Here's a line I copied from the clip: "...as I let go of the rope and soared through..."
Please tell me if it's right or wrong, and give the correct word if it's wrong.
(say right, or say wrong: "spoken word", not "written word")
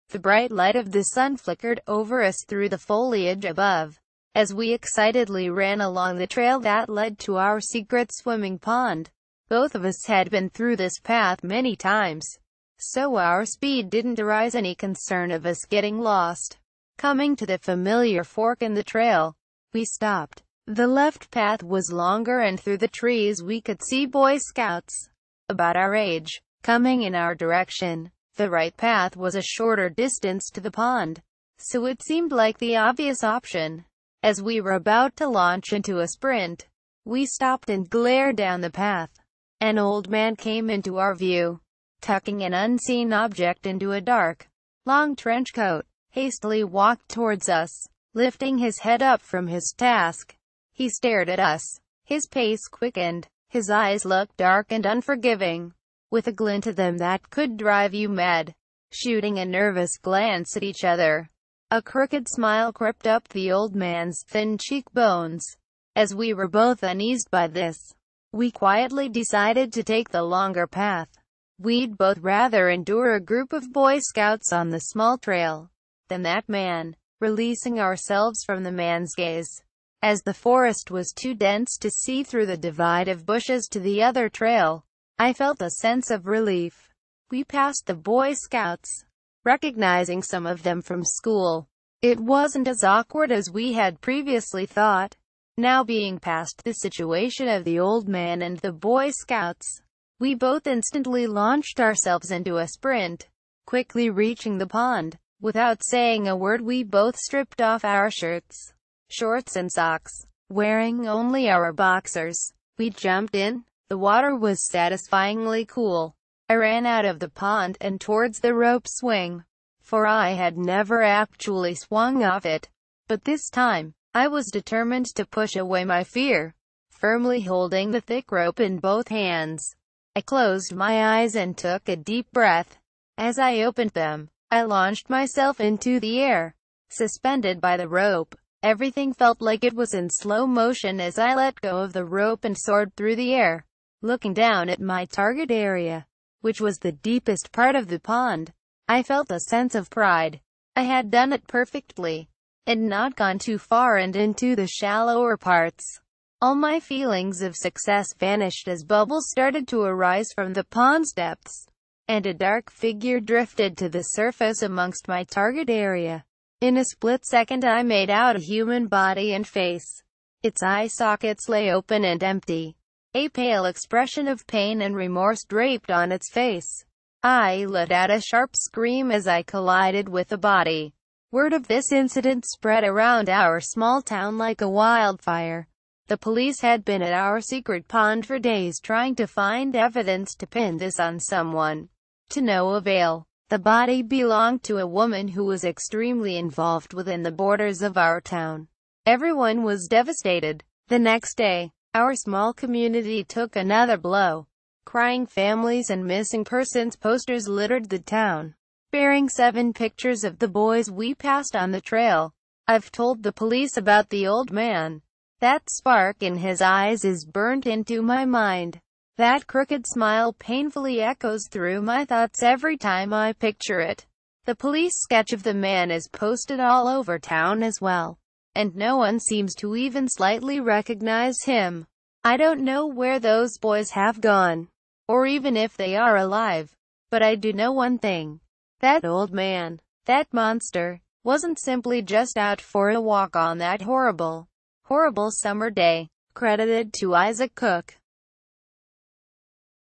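right.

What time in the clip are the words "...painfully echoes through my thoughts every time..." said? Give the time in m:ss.
3:40.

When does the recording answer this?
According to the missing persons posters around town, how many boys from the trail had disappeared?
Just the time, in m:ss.
3:29.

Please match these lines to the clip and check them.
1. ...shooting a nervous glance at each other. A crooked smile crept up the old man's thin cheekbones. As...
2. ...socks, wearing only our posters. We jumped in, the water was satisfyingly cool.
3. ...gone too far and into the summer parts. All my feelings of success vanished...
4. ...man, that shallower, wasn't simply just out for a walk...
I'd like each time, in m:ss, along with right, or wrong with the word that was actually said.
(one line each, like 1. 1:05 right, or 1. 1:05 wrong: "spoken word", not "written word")
1. 0:58 right
2. 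1:49 wrong: "boxers", not "posters"
3. 2:33 wrong: "shallower", not "summer"
4. 3:59 wrong: "monster", not "shallower".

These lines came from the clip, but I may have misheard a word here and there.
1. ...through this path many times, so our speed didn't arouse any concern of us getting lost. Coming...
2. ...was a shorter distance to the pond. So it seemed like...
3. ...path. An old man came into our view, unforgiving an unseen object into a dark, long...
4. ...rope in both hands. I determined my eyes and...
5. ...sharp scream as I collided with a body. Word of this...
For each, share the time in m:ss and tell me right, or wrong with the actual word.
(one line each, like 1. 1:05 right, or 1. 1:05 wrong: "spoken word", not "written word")
1. 0:10 right
2. 0:29 right
3. 0:38 wrong: "tucking", not "unforgiving"
4. 2:08 wrong: "closed", not "determined"
5. 2:58 right.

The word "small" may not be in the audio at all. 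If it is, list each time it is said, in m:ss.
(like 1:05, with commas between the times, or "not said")
1:14, 3:03, 3:22.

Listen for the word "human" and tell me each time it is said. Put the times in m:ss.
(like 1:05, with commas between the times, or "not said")
2:48.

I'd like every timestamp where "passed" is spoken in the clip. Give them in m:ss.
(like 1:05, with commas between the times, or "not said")
1:27, 3:31.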